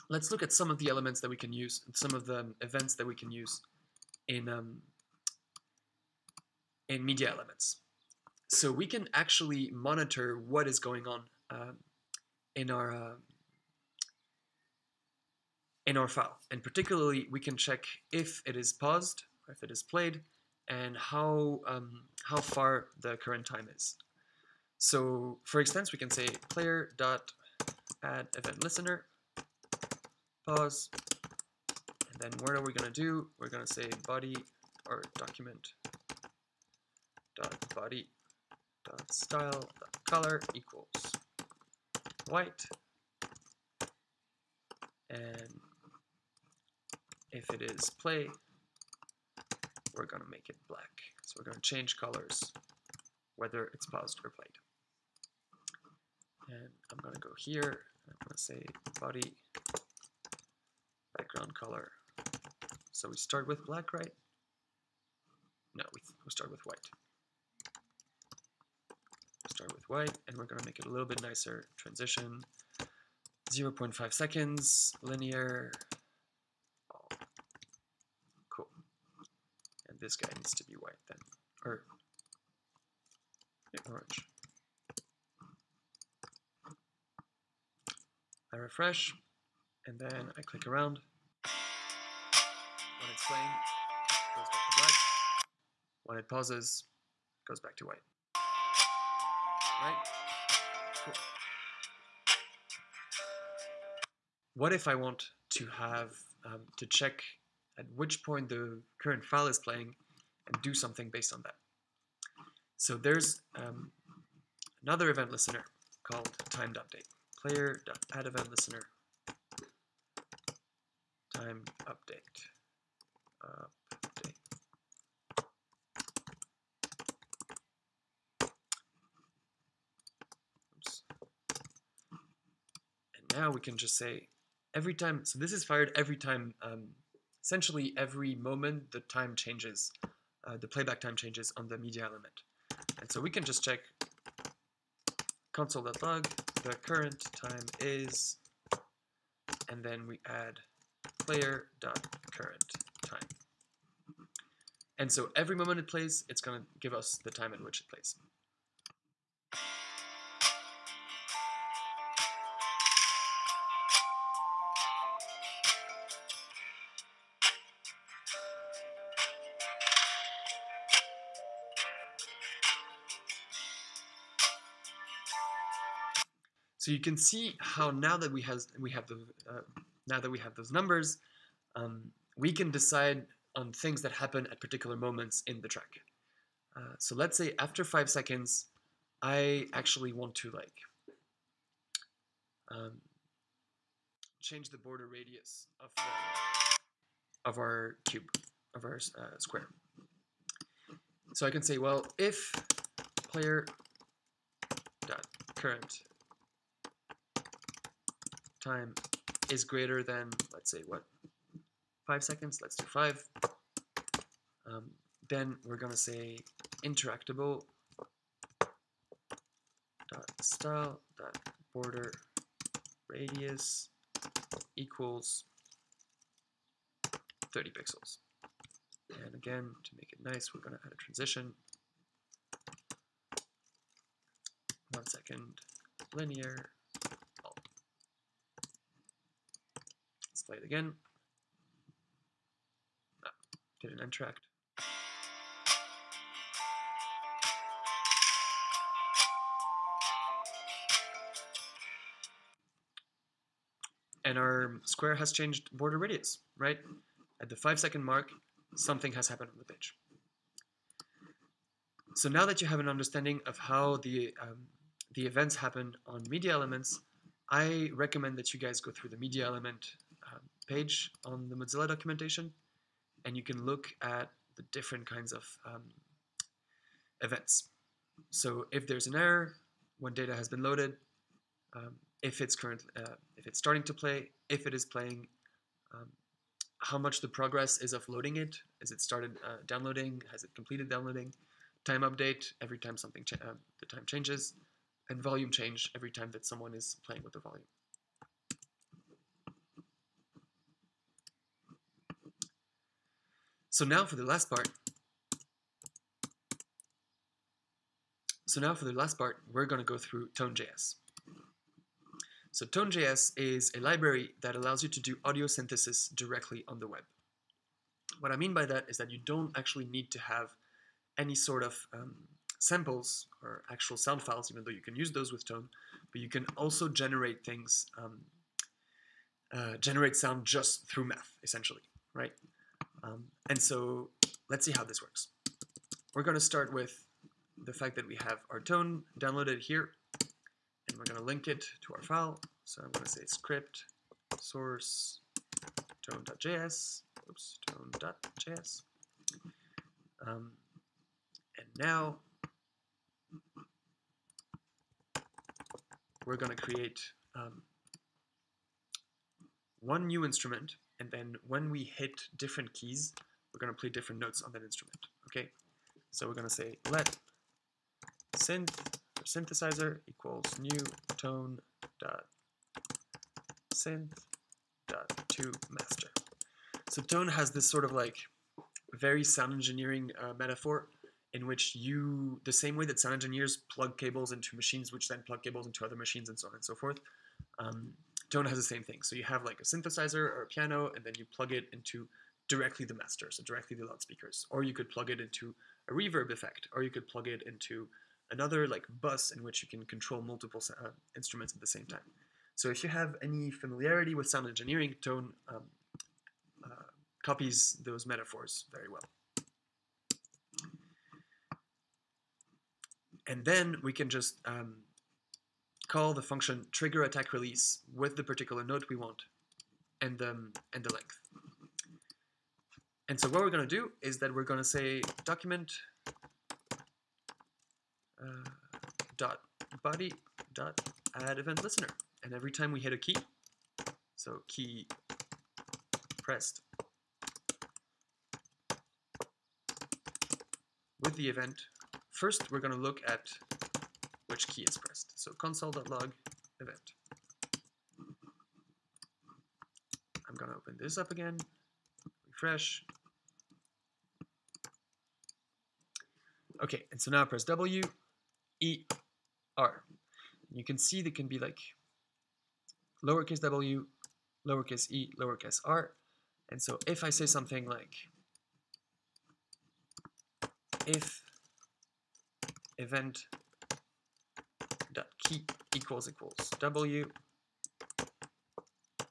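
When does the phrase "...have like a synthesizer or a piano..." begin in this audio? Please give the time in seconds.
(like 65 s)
389 s.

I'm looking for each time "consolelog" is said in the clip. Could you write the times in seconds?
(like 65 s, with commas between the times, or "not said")
145 s, 445 s.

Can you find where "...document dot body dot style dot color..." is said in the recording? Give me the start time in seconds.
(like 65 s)
35 s.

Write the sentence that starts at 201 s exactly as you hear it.
So I can say, well, if player dot current time is greater than, let's say, what five seconds, let's do five.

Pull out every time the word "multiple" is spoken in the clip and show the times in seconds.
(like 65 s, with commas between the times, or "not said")
400 s.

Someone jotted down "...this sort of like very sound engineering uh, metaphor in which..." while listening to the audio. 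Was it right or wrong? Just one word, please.
right.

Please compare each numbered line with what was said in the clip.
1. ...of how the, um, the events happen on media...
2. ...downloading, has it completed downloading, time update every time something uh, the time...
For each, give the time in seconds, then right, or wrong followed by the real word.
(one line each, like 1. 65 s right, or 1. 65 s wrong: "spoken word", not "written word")
1. 263 s right
2. 289 s right.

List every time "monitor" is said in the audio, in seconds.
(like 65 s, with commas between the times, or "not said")
9 s.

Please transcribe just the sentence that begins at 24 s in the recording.
So for instance, we can say player dot add event listener pause.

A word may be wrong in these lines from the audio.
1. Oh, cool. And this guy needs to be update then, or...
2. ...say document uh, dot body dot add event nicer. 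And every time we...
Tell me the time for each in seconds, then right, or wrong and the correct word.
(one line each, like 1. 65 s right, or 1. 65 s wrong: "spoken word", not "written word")
1. 76 s wrong: "white", not "update"
2. 424 s wrong: "listener", not "nicer".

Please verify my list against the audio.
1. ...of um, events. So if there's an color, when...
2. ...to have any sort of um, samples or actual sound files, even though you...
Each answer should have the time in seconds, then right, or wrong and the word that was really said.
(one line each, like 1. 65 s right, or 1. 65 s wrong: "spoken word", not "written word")
1. 275 s wrong: "error", not "color"
2. 320 s right.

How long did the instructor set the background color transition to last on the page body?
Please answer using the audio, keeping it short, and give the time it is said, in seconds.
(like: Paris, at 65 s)
0.5 seconds, at 73 s.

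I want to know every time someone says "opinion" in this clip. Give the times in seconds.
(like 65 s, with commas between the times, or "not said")
not said.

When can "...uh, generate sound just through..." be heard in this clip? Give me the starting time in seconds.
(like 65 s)
329 s.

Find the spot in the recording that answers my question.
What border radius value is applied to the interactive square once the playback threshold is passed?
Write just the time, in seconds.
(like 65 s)
227 s.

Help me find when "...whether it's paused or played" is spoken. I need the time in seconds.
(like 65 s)
53 s.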